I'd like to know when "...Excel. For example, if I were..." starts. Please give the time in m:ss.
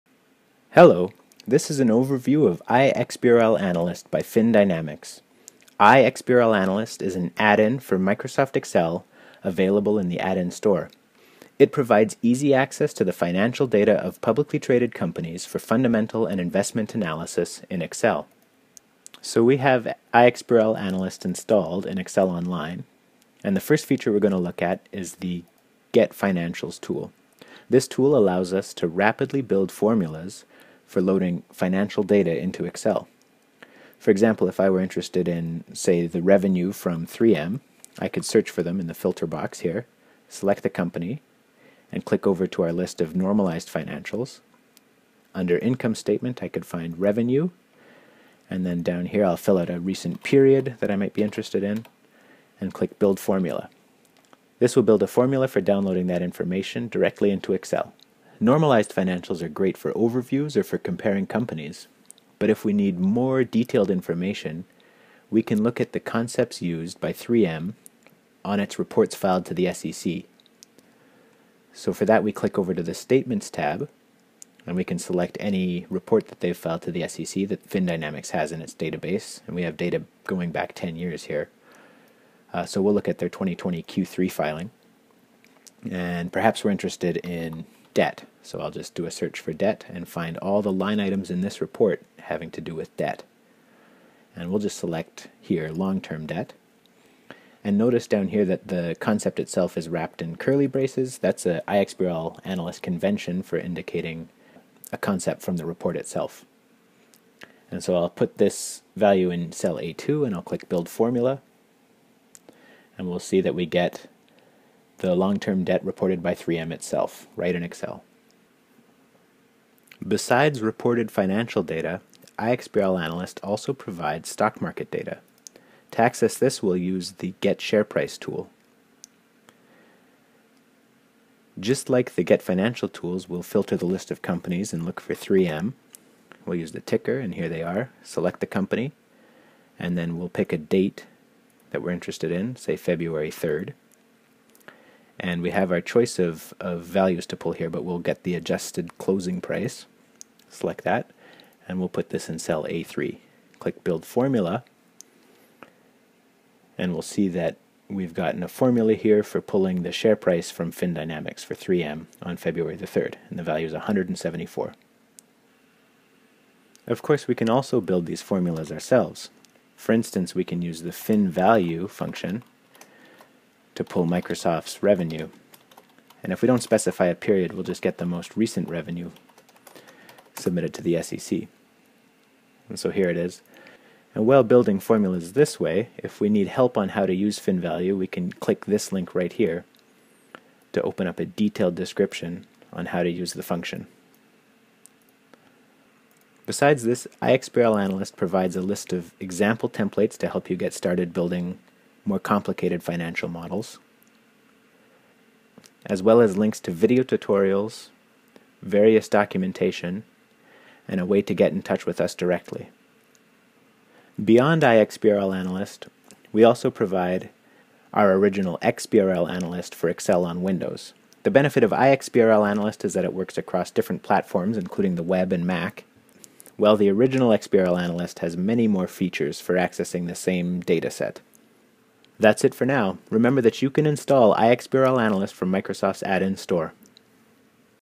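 0:32.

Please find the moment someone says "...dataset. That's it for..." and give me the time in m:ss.
3:50.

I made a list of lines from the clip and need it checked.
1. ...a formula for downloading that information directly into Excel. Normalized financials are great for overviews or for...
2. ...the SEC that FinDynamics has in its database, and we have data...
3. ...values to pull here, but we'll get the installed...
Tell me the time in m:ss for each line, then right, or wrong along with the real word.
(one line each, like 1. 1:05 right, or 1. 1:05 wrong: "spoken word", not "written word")
1. 0:55 right
2. 1:16 right
3. 2:26 wrong: "adjusted", not "installed".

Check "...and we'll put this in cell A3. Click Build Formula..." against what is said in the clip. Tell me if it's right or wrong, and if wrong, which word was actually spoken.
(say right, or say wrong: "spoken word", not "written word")
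right.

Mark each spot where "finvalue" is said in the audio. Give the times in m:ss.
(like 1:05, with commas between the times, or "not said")
2:50, 3:07.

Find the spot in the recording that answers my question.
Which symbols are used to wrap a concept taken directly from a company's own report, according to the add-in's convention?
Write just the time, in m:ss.
1:40.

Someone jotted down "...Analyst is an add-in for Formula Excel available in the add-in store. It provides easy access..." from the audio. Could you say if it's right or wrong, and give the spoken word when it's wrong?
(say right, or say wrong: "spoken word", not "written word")
wrong: "Microsoft", not "Formula".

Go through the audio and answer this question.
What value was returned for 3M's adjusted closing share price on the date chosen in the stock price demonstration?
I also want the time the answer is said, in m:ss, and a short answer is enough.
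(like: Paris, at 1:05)
174, at 2:43.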